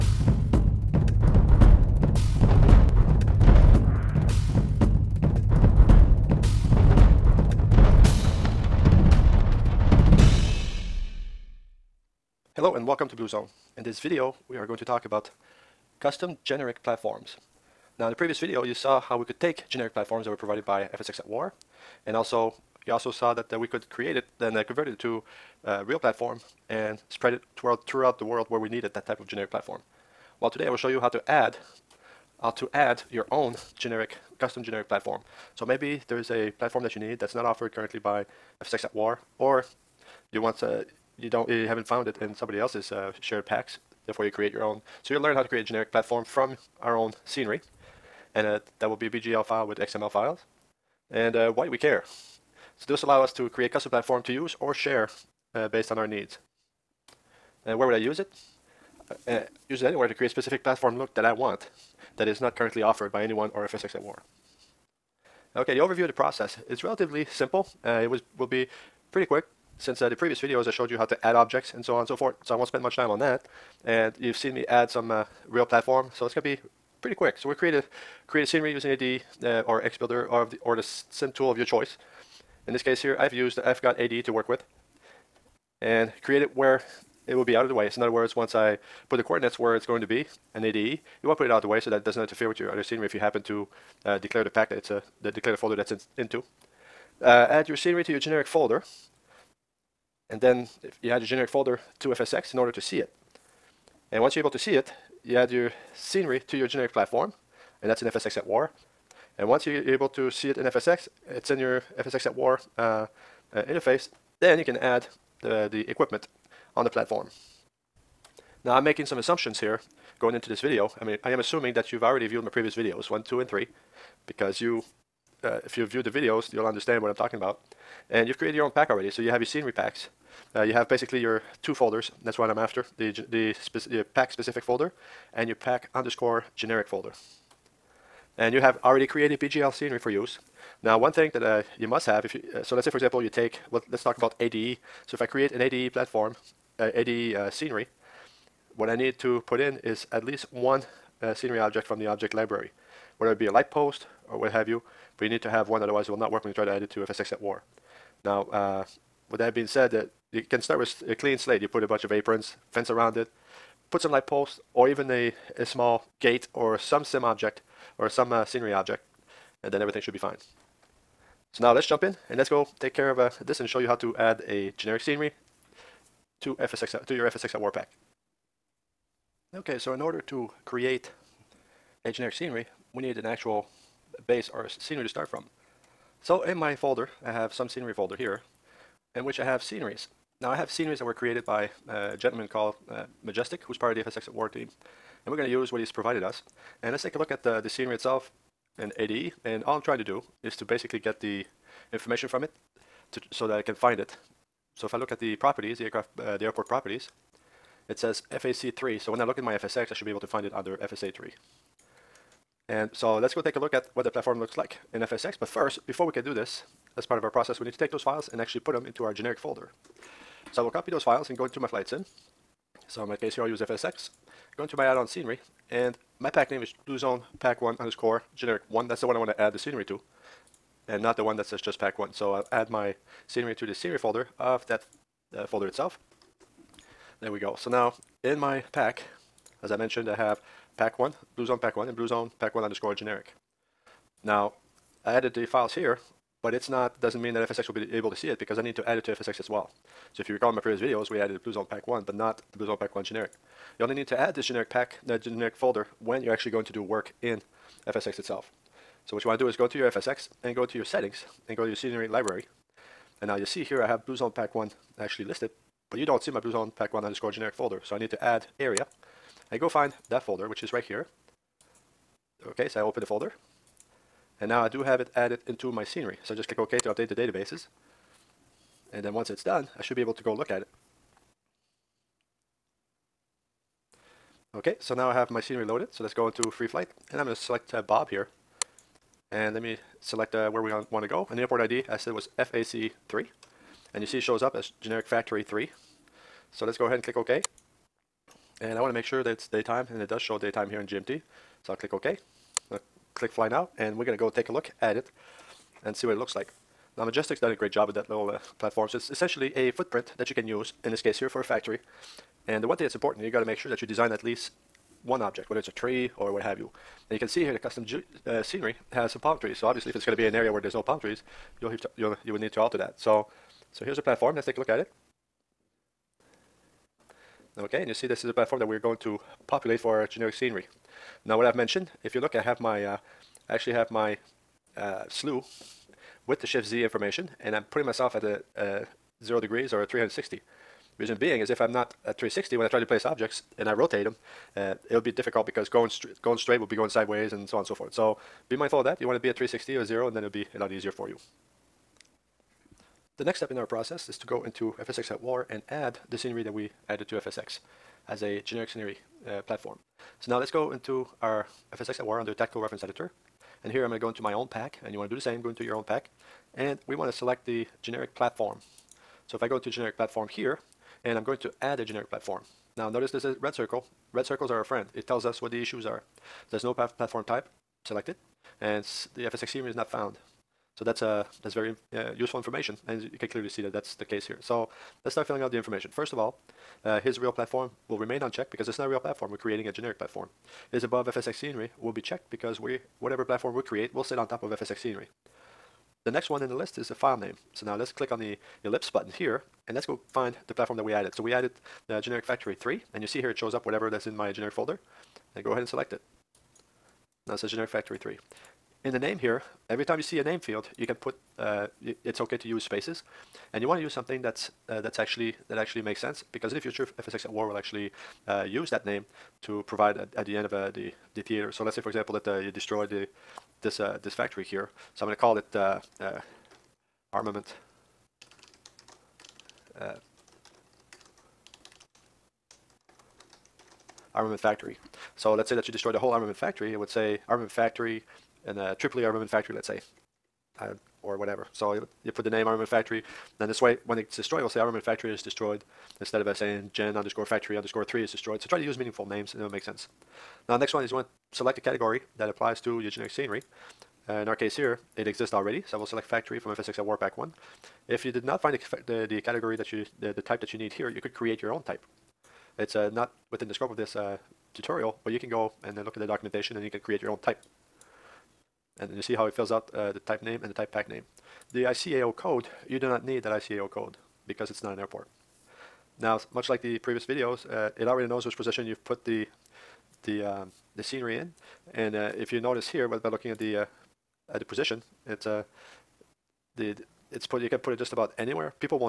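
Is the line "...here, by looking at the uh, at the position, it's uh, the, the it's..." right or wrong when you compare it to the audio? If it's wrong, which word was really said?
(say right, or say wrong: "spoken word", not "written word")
right.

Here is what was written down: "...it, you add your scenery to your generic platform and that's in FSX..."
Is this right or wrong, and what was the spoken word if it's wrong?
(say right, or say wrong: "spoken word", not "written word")
right.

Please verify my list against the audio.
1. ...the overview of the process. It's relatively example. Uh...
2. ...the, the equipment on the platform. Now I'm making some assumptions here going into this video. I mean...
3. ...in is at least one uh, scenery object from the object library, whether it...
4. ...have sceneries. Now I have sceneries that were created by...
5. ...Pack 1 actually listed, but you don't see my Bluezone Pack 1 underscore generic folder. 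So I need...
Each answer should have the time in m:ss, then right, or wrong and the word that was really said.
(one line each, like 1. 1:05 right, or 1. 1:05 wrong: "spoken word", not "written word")
1. 1:05 wrong: "simple", not "example"
2. 1:55 right
3. 2:29 right
4. 3:09 right
5. 4:24 right.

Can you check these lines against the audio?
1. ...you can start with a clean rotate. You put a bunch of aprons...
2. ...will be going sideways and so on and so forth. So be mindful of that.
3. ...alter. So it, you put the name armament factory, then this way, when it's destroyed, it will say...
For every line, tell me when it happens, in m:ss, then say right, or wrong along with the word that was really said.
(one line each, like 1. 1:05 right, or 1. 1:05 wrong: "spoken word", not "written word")
1. 2:40 wrong: "slate", not "rotate"
2. 5:46 right
3. 7:21 wrong: "whatever", not "alter".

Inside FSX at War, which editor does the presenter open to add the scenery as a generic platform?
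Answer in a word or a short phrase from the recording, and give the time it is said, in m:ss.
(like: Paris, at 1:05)
Tactical Reference Editor, at 6:02.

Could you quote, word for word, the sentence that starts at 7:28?
So try to use meaningful names and it'll make sense.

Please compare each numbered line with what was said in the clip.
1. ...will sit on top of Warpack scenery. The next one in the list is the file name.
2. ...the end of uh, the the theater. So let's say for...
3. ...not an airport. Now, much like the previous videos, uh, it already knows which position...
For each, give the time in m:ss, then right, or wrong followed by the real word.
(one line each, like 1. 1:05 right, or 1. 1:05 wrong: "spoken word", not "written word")
1. 6:33 wrong: "FSX", not "Warpack"
2. 7:00 right
3. 7:54 right.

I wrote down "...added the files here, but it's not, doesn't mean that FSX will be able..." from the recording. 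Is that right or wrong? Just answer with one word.
right.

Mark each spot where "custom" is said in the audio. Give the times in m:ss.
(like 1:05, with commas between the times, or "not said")
0:16, 0:34, 0:53, 5:17.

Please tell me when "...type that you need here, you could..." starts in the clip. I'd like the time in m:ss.
7:40.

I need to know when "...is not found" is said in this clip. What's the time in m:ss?
6:19.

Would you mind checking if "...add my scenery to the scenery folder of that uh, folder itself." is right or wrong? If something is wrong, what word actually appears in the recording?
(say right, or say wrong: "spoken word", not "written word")
right.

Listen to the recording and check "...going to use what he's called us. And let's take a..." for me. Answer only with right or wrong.
wrong.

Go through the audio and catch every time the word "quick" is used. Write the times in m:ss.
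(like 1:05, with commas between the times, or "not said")
1:09, 1:17.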